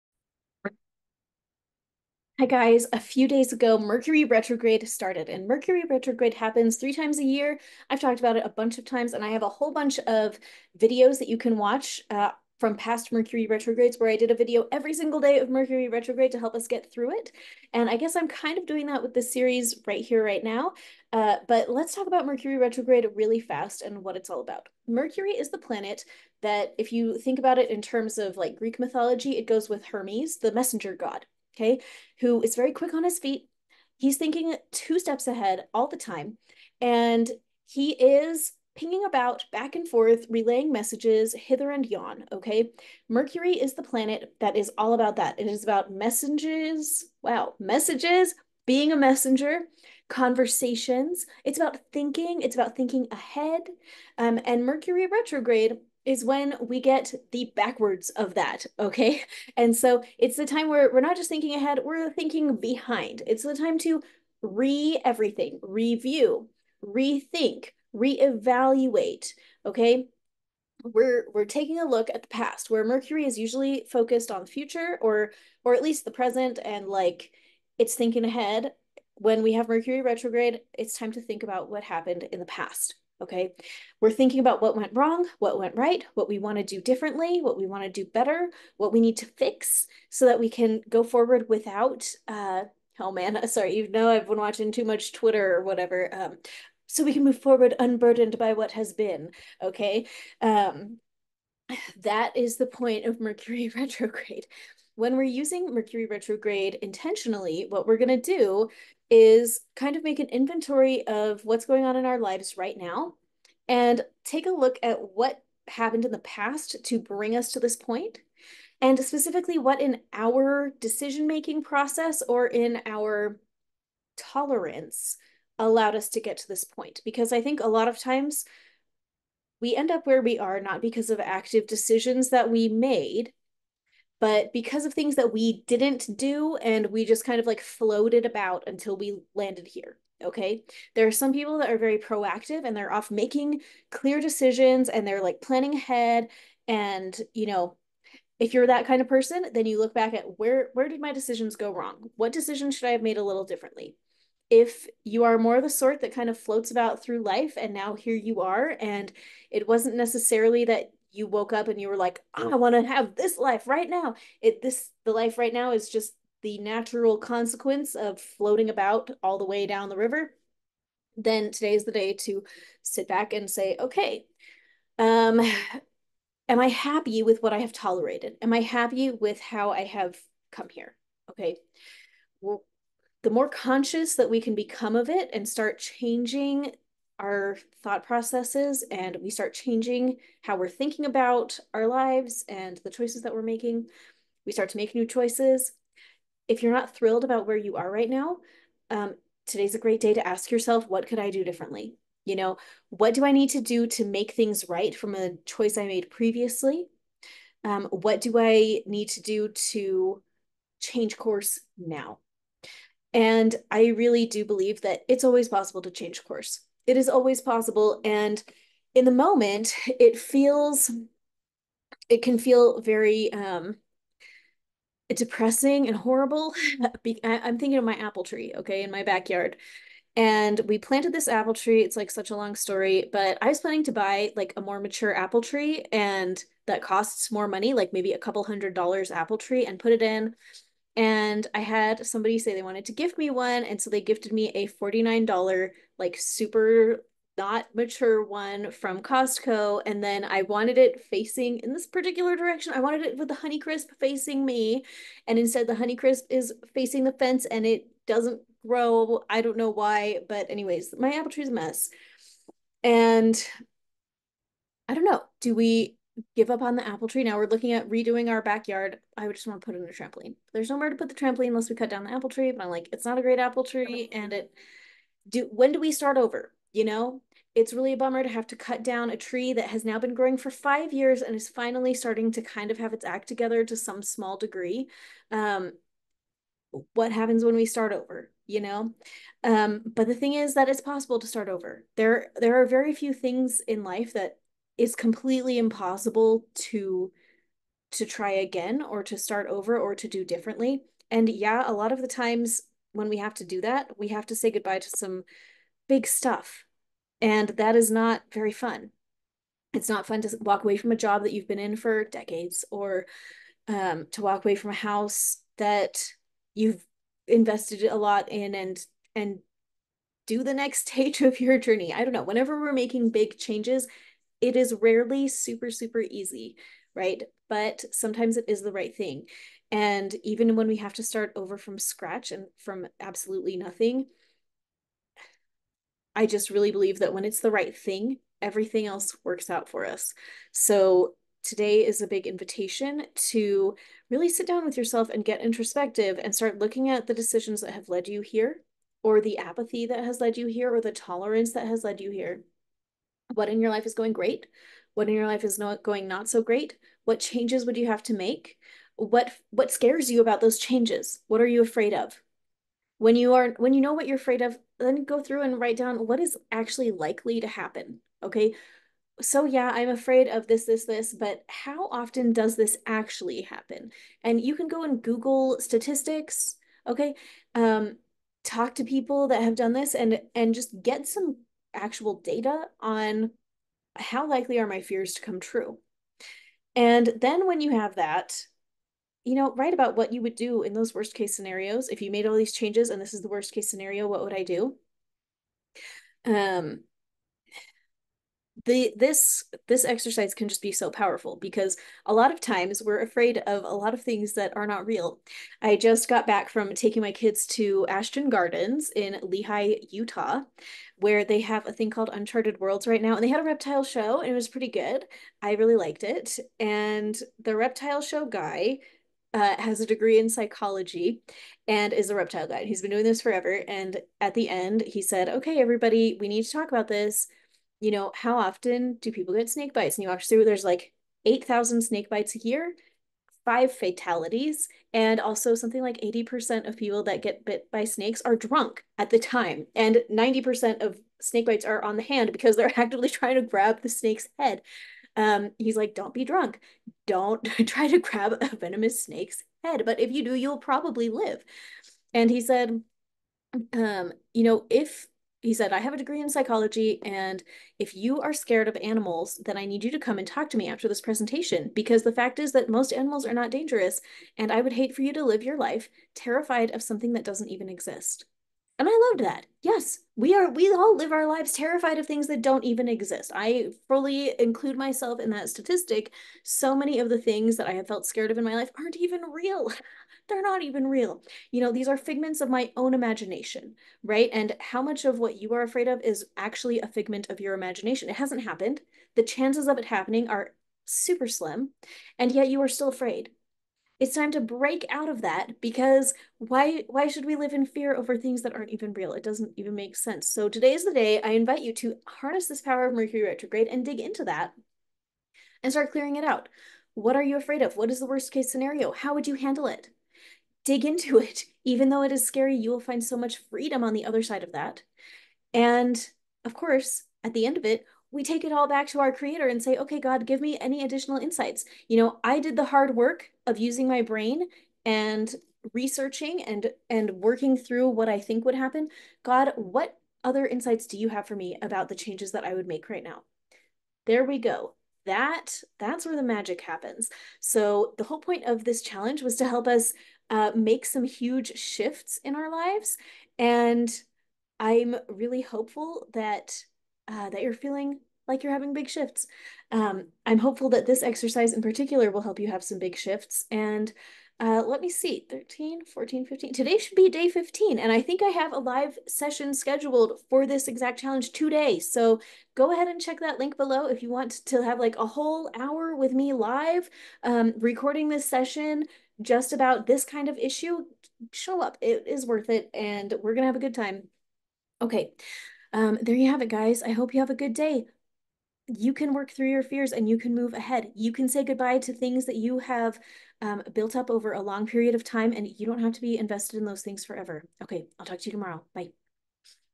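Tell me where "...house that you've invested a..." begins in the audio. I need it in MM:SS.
05:14.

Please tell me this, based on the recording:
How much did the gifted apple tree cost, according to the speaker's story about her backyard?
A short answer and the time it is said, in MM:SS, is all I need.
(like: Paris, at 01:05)
$49, at 04:04.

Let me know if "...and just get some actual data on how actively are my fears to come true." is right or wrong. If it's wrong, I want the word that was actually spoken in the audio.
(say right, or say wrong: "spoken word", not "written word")
wrong: "likely", not "actively".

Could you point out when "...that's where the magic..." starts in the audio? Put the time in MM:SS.
08:55.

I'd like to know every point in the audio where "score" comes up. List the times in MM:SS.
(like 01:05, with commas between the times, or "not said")
not said.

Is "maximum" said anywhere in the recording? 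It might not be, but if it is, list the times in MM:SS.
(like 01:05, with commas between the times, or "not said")
not said.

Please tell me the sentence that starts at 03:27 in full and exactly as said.
Um, what do I need to do to change course now?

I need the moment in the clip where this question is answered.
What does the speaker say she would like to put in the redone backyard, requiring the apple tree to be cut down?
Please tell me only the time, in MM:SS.
04:29.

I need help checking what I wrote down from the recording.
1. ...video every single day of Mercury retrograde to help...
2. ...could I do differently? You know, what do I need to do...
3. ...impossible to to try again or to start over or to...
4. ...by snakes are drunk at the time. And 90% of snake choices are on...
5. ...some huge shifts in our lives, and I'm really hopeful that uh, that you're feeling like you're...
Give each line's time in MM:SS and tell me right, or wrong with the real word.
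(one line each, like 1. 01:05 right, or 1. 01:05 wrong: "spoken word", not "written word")
1. 00:14 right
2. 03:21 right
3. 04:55 right
4. 07:17 wrong: "bites", not "choices"
5. 09:00 right.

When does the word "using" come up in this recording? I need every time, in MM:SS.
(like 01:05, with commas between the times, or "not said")
01:45, 08:43.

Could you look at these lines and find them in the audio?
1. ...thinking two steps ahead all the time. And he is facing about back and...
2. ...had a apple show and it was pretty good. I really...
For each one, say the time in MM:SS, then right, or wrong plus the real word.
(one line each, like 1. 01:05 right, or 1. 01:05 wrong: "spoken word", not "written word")
1. 00:34 wrong: "pinging", not "facing"
2. 06:53 wrong: "reptile", not "apple".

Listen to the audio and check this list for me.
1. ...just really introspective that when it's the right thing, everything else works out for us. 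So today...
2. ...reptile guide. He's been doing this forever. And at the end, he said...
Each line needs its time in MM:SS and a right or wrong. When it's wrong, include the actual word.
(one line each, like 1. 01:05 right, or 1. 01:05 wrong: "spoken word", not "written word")
1. 05:36 wrong: "believe", not "introspective"
2. 07:02 right.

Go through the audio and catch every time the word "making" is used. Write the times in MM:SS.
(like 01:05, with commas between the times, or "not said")
02:01, 02:23, 03:13, 05:22.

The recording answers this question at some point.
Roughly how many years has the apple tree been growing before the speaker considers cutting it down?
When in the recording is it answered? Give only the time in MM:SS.
04:40.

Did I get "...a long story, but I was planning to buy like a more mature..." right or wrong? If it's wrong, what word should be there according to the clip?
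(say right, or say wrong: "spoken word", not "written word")
right.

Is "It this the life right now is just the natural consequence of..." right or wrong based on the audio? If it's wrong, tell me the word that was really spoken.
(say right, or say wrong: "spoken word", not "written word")
right.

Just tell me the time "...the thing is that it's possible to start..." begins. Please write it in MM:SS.
04:50.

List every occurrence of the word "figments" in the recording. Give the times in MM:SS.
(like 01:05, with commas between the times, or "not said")
08:01, 08:06.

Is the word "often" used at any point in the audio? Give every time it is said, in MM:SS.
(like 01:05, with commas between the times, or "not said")
06:11, 07:08.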